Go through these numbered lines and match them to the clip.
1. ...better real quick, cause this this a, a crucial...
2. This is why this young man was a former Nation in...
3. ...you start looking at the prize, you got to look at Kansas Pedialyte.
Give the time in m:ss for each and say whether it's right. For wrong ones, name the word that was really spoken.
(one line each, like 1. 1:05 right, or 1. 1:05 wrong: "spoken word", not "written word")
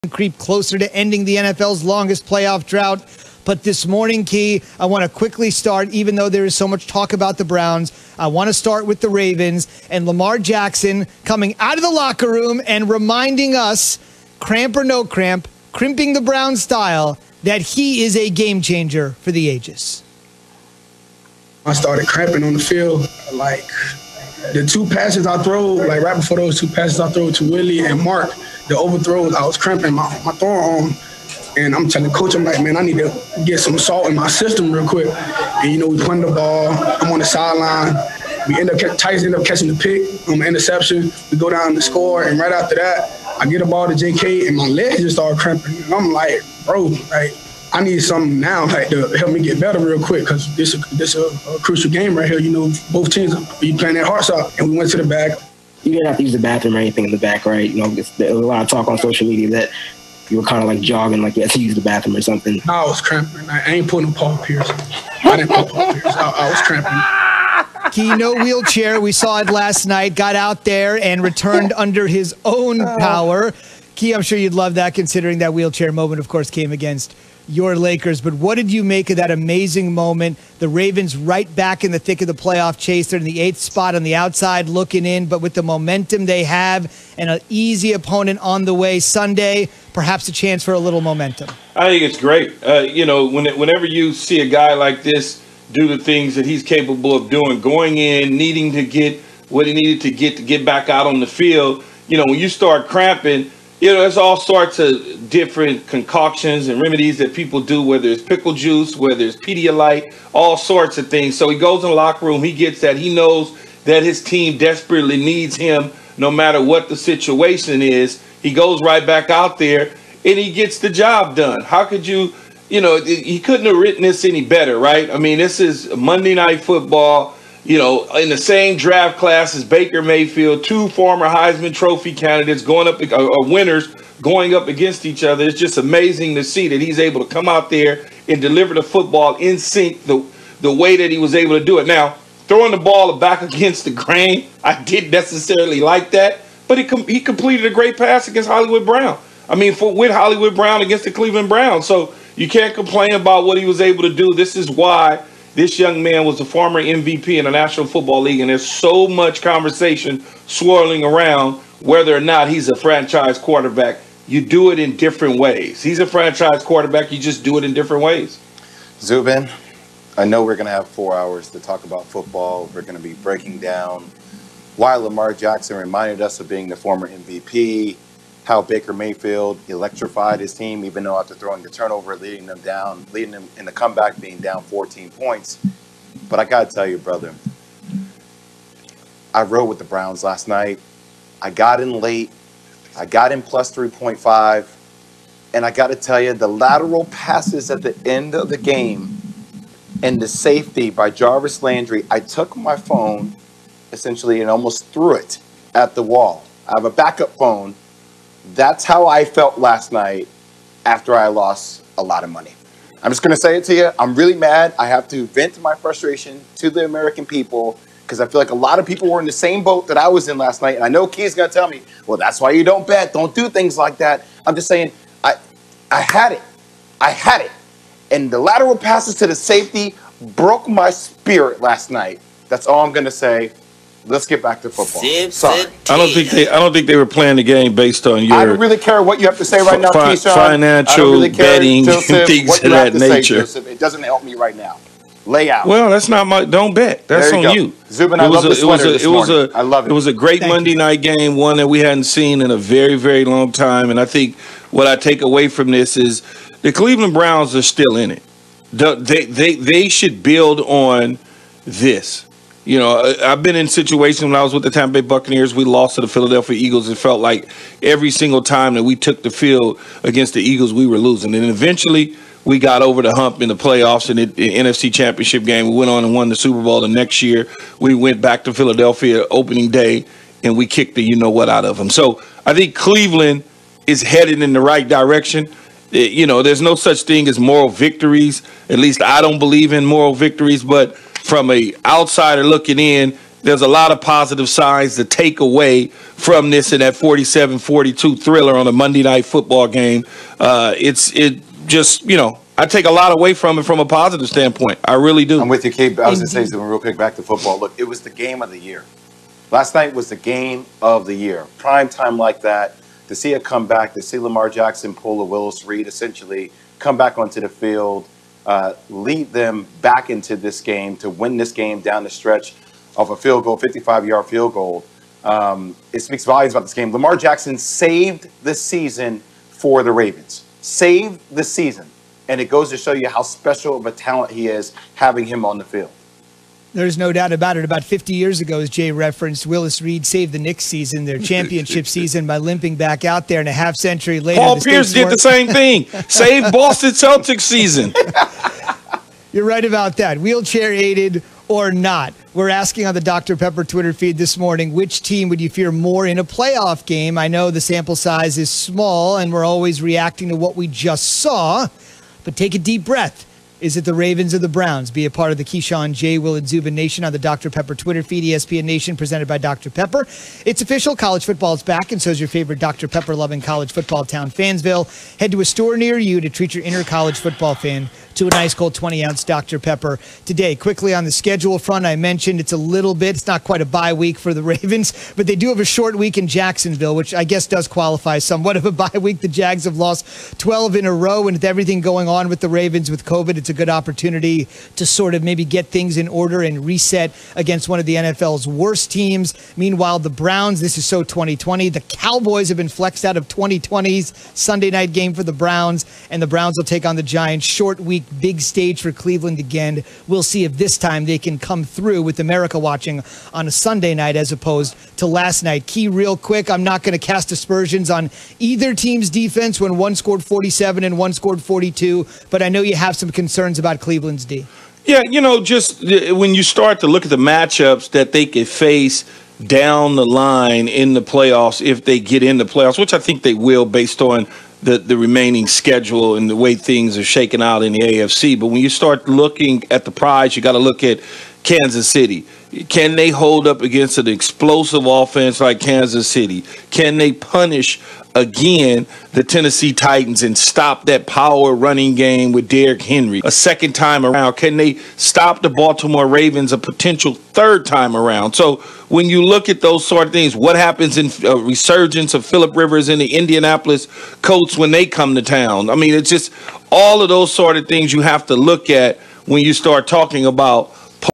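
1. 0:49 right
2. 2:34 wrong: "MVP", not "Nation"
3. 7:18 wrong: "City", not "Pedialyte".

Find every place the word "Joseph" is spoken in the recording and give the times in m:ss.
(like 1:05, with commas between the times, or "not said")
4:01.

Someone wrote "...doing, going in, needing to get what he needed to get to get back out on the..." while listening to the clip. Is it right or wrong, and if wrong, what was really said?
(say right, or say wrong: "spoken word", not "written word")
right.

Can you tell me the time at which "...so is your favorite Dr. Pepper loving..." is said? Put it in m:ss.
6:12.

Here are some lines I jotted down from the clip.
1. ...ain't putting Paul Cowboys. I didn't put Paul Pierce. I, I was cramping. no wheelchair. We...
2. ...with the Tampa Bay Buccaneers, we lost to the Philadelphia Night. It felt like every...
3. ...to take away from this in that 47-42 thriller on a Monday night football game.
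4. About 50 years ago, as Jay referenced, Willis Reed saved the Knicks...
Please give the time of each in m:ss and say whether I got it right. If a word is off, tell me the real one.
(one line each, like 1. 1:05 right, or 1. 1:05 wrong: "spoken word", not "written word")
1. 1:03 wrong: "Pierce", not "Cowboys"
2. 4:24 wrong: "Eagles", not "Night"
3. 4:54 right
4. 5:37 right.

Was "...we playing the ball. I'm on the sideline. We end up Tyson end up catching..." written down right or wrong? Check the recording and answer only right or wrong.
right.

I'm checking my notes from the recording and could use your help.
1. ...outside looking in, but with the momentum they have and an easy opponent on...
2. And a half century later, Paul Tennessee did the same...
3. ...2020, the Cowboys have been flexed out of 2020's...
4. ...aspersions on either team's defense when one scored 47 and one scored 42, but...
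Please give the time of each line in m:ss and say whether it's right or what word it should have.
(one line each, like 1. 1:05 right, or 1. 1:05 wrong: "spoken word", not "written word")
1. 1:24 right
2. 5:43 wrong: "Pierce", not "Tennessee"
3. 6:41 right
4. 6:57 right.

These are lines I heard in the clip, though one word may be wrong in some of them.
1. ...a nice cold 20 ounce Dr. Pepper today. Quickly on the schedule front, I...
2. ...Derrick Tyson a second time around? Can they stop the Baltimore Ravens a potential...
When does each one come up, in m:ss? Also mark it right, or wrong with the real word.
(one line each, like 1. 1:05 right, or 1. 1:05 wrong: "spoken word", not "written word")
1. 6:18 right
2. 7:32 wrong: "Henry", not "Tyson".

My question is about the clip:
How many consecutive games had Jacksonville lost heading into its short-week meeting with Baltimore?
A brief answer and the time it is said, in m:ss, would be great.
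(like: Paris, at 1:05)
12, at 6:30.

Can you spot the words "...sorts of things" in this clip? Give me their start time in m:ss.
1:50.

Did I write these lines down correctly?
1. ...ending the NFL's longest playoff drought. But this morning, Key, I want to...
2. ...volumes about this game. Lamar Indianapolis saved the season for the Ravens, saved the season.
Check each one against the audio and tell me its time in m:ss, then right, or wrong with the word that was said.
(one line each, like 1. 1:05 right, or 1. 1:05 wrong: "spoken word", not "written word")
1. 0:00 right
2. 5:26 wrong: "Jackson", not "Indianapolis".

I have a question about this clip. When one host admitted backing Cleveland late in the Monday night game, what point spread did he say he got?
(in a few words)
+3.5.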